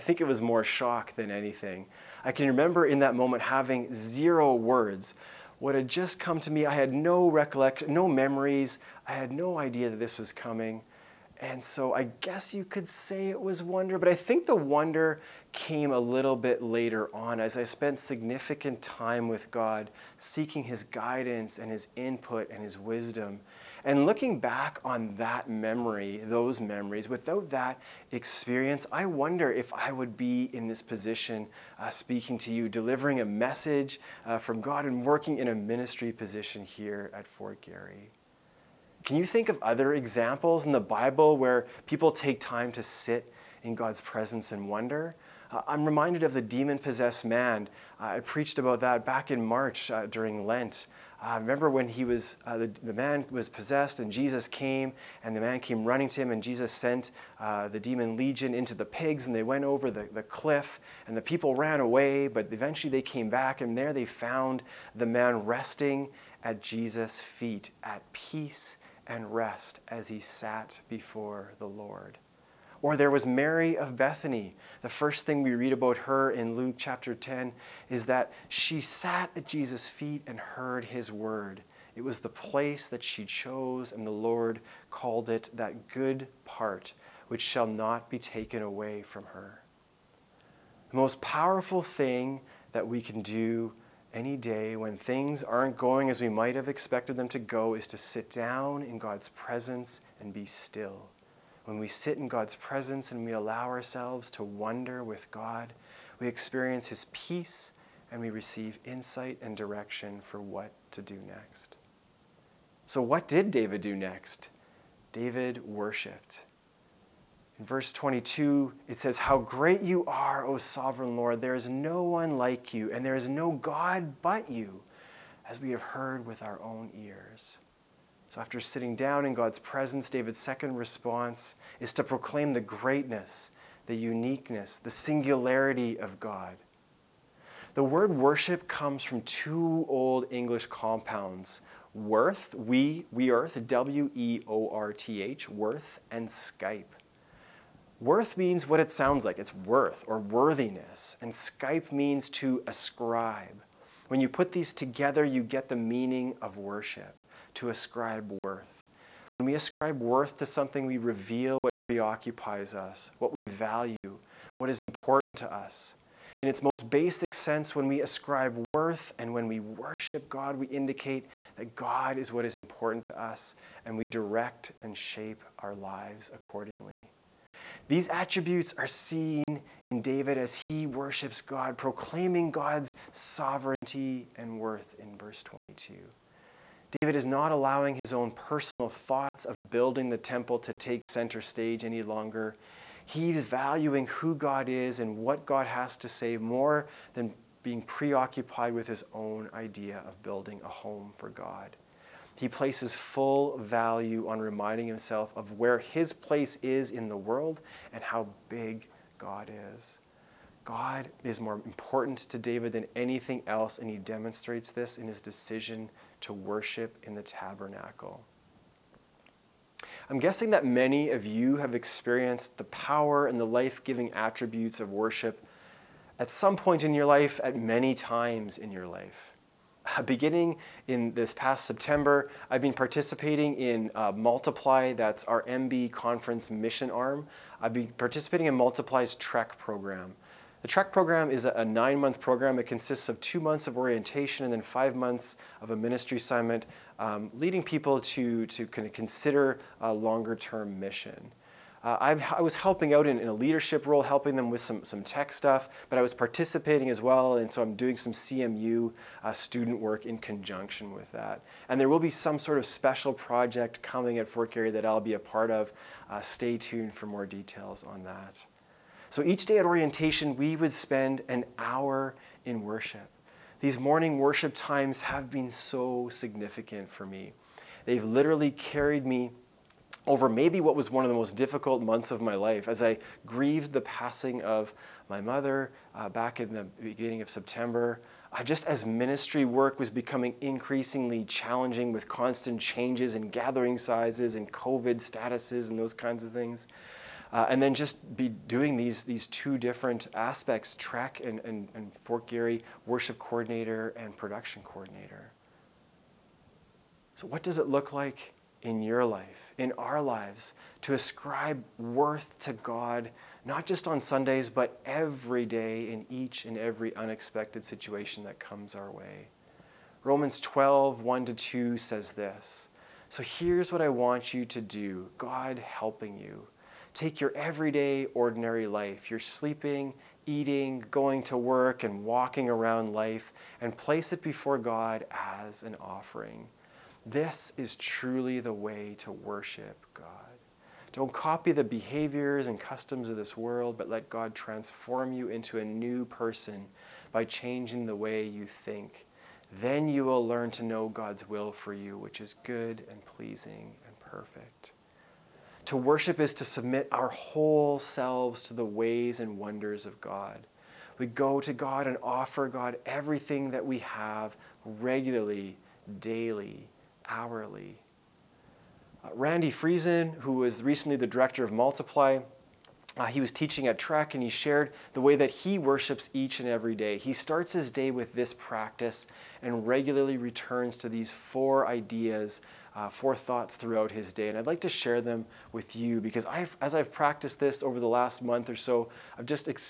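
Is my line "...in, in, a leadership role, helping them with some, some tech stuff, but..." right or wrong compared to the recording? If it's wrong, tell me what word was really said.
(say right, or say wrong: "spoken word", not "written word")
right.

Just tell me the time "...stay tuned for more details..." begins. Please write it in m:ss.
4:26.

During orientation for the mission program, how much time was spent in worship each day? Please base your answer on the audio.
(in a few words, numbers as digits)
an hour.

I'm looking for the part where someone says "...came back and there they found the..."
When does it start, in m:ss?
1:03.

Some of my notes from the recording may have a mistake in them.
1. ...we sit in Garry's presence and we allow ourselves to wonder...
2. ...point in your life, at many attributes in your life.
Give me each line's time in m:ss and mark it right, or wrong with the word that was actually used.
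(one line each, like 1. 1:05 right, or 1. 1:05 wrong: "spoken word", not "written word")
1. 1:41 wrong: "God", not "Garry"
2. 3:46 wrong: "times", not "attributes".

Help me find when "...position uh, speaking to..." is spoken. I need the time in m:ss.
0:30.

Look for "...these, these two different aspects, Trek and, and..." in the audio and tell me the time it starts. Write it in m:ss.
4:58.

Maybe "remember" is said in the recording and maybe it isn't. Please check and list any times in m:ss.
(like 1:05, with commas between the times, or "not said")
0:02, 0:51.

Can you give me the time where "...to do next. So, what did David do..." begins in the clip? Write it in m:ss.
1:50.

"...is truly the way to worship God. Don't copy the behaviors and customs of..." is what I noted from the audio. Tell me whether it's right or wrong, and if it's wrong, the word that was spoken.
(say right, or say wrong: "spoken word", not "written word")
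right.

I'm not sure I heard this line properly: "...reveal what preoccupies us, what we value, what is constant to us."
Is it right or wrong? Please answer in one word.
wrong.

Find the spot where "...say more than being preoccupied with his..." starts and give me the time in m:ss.
3:16.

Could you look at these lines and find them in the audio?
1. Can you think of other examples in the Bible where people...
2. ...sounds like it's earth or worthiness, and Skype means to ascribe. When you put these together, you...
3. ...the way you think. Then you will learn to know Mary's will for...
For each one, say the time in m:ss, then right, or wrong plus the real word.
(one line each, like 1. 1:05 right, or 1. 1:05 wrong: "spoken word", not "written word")
1. 0:39 right
2. 2:28 wrong: "worth", not "earth"
3. 5:47 wrong: "God", not "Mary".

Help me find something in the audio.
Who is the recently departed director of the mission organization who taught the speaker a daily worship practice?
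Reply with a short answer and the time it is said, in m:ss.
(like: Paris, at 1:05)
Randy Friesen, at 6:09.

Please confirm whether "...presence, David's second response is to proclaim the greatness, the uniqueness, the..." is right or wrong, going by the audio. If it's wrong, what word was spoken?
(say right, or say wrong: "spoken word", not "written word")
right.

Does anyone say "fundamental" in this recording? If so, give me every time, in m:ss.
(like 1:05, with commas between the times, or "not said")
not said.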